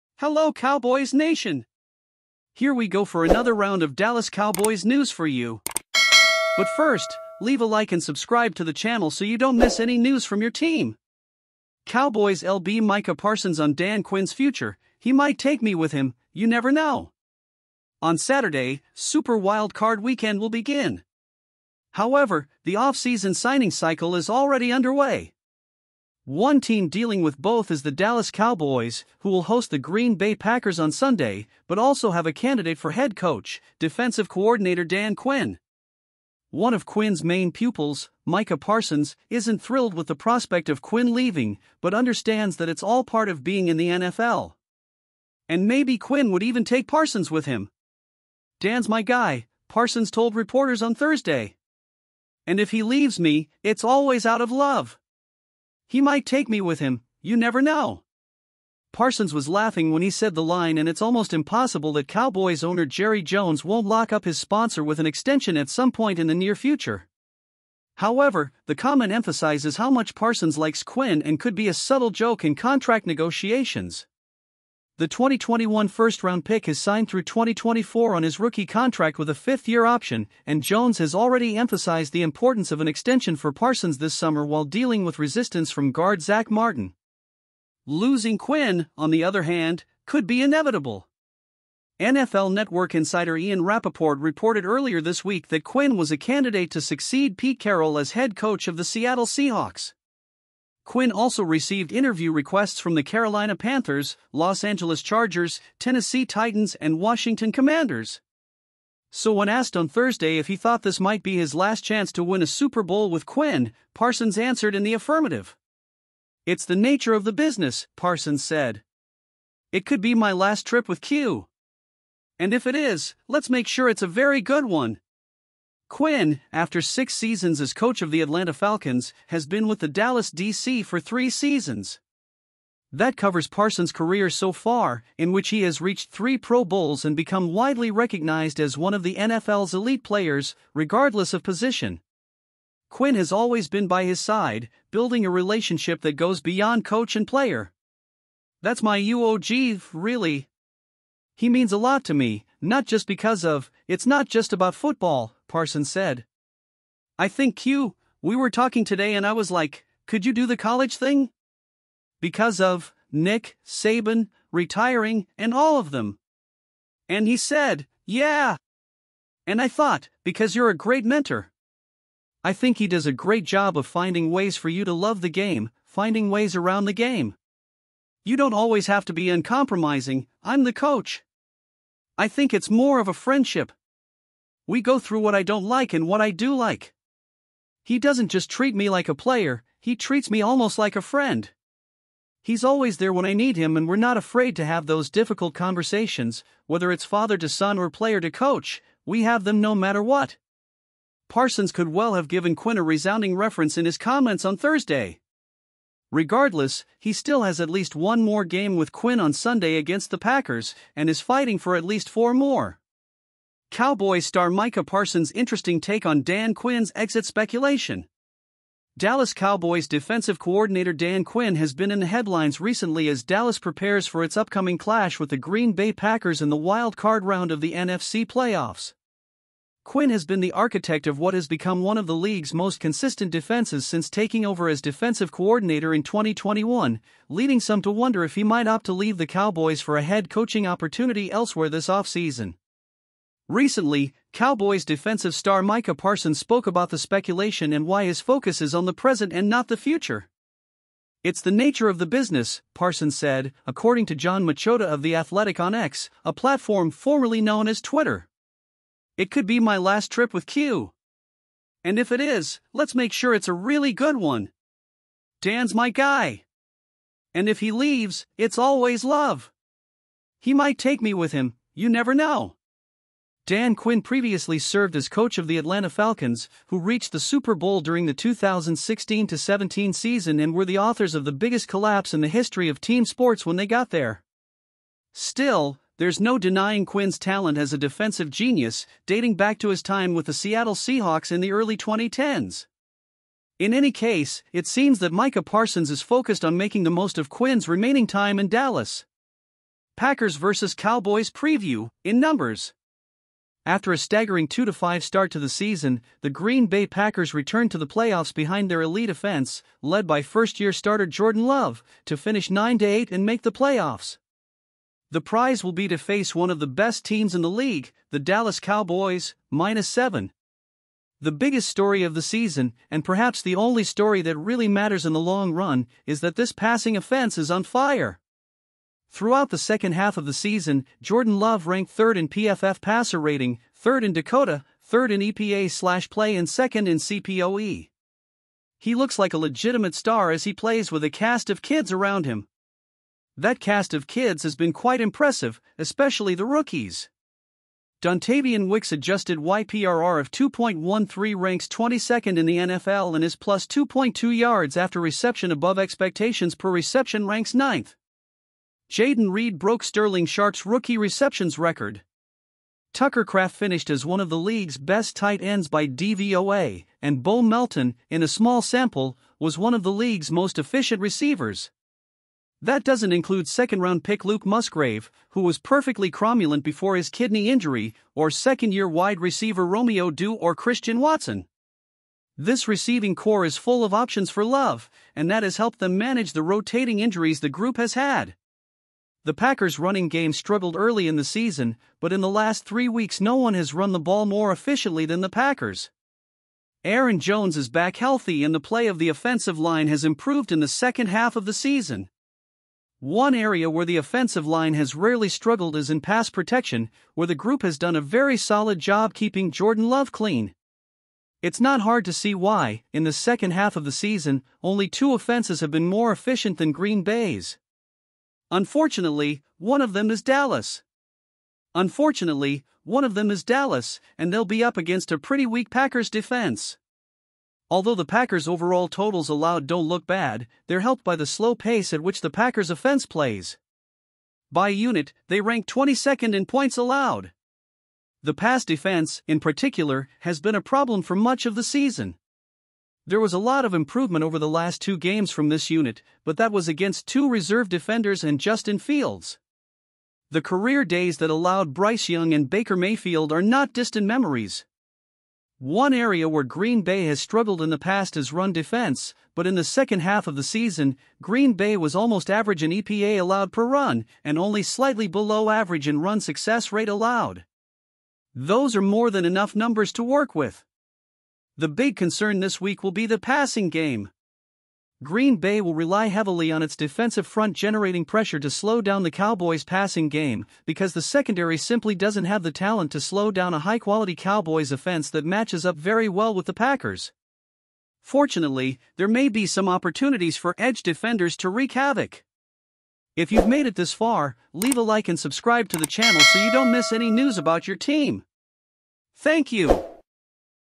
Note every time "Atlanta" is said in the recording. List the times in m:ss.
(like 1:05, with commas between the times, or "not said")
2:08, 4:35.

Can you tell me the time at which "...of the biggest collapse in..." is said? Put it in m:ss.
4:41.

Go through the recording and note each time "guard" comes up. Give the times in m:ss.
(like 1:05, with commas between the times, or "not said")
1:25.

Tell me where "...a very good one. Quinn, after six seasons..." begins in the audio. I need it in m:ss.
2:04.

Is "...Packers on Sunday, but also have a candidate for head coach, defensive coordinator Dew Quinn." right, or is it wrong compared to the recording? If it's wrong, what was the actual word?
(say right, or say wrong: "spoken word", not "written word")
wrong: "Dan", not "Dew".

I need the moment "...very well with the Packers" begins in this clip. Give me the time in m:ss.
8:05.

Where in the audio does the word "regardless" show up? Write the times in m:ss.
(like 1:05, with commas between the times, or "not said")
2:20, 3:26.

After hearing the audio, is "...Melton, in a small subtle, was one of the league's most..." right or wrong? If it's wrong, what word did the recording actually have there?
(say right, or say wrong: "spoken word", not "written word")
wrong: "sample", not "subtle".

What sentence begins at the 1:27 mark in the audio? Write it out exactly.
Losing Quinn, on the other hand, could be inevitable.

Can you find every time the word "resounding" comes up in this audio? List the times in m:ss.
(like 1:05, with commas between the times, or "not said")
3:22.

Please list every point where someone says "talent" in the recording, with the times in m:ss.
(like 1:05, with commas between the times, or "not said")
4:47, 8:02.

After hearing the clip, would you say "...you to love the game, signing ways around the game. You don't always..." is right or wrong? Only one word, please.
wrong.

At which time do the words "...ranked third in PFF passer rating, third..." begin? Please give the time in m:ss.
5:31.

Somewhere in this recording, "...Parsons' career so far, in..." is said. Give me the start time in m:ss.
2:13.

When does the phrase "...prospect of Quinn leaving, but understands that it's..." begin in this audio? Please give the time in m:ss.
0:40.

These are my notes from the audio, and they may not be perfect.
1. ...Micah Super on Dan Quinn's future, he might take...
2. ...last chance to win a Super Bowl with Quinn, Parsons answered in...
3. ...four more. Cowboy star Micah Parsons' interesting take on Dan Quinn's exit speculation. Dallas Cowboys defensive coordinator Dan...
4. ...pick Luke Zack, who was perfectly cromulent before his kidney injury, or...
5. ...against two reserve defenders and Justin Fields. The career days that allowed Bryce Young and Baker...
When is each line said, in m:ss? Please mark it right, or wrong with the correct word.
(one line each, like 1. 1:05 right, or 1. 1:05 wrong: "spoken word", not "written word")
1. 0:12 wrong: "Parsons", not "Super"
2. 1:51 right
3. 3:32 right
4. 6:14 wrong: "Musgrave", not "Zack"
5. 7:26 right.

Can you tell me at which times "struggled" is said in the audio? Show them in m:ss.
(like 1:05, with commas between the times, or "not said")
6:30, 6:45, 7:37.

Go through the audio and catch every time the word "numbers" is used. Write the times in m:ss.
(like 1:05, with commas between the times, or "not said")
5:02, 7:49.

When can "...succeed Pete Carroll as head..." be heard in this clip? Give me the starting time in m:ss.
1:36.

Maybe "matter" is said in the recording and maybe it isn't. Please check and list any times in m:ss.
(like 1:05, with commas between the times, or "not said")
3:19, 5:24.